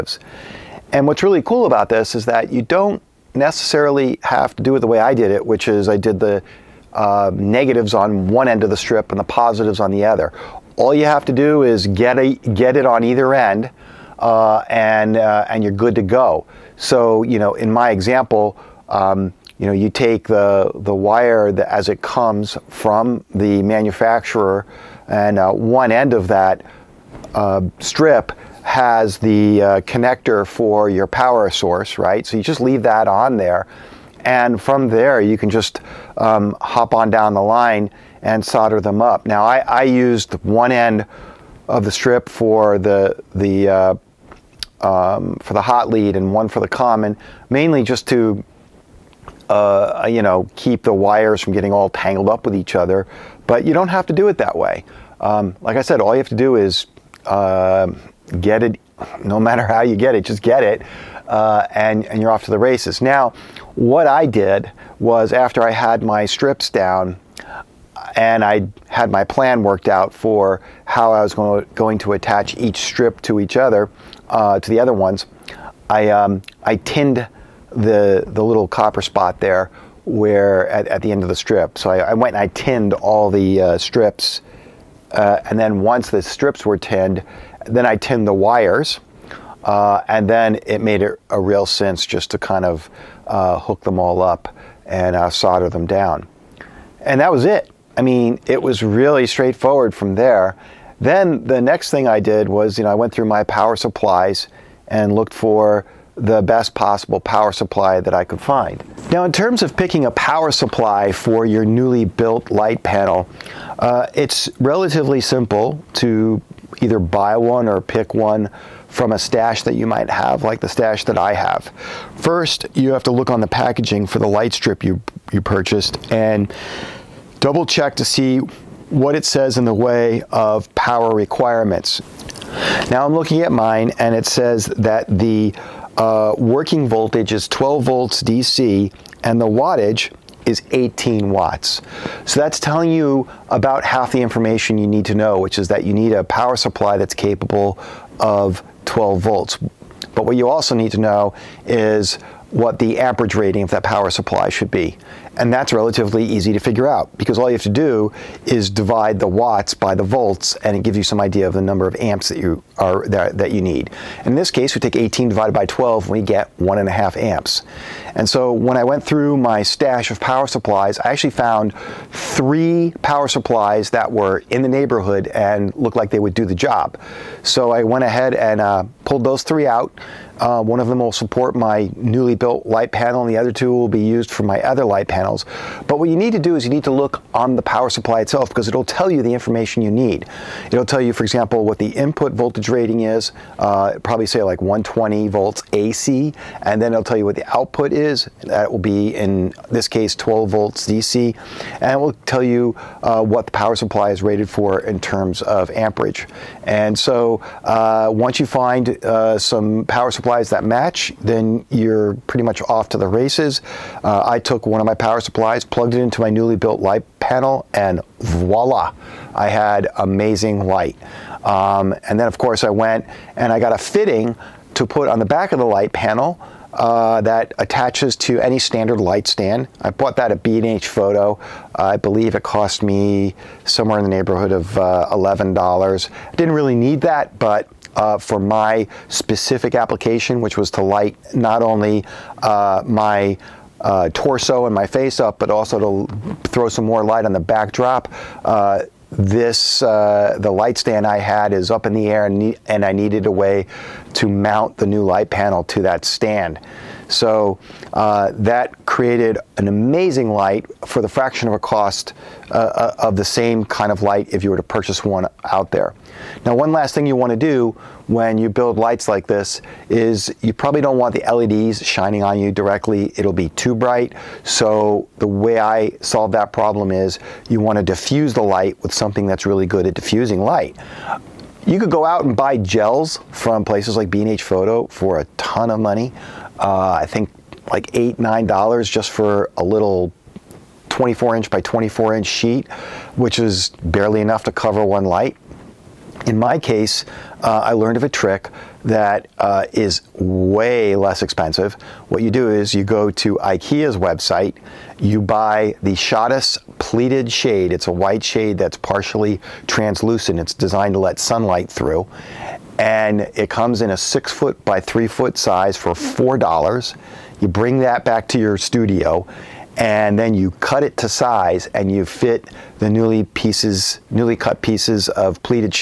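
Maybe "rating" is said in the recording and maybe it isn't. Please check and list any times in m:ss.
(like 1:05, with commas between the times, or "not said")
2:33, 3:12.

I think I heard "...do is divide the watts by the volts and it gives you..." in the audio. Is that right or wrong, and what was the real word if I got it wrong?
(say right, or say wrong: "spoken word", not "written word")
right.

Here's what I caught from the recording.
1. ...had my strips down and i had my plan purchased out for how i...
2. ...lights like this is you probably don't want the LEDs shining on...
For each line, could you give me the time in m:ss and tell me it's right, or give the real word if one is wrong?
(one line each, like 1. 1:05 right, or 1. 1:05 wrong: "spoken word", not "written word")
1. 1:05 wrong: "worked", not "purchased"
2. 4:28 right.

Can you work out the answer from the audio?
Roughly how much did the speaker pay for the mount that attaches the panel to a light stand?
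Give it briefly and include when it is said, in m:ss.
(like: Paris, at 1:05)
$11, at 3:55.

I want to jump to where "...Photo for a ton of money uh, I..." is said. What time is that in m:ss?
4:44.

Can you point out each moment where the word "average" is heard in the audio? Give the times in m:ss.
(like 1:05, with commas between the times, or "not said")
2:32.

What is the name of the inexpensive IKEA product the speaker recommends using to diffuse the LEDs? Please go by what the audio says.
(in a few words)
Schottis pleated shade.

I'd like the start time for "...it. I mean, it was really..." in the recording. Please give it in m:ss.
1:37.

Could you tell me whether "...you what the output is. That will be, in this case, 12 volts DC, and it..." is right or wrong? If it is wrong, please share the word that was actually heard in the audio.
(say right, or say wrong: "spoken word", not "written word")
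right.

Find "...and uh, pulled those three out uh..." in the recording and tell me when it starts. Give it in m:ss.
2:58.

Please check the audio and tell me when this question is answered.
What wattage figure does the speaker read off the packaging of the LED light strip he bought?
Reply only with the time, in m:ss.
2:20.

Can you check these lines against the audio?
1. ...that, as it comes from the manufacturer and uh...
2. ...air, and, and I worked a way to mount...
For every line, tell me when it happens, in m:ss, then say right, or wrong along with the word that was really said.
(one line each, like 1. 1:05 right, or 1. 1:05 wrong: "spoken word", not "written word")
1. 0:21 right
2. 4:12 wrong: "needed", not "worked".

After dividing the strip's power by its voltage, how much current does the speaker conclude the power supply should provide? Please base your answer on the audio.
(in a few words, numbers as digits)
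1.5 amps.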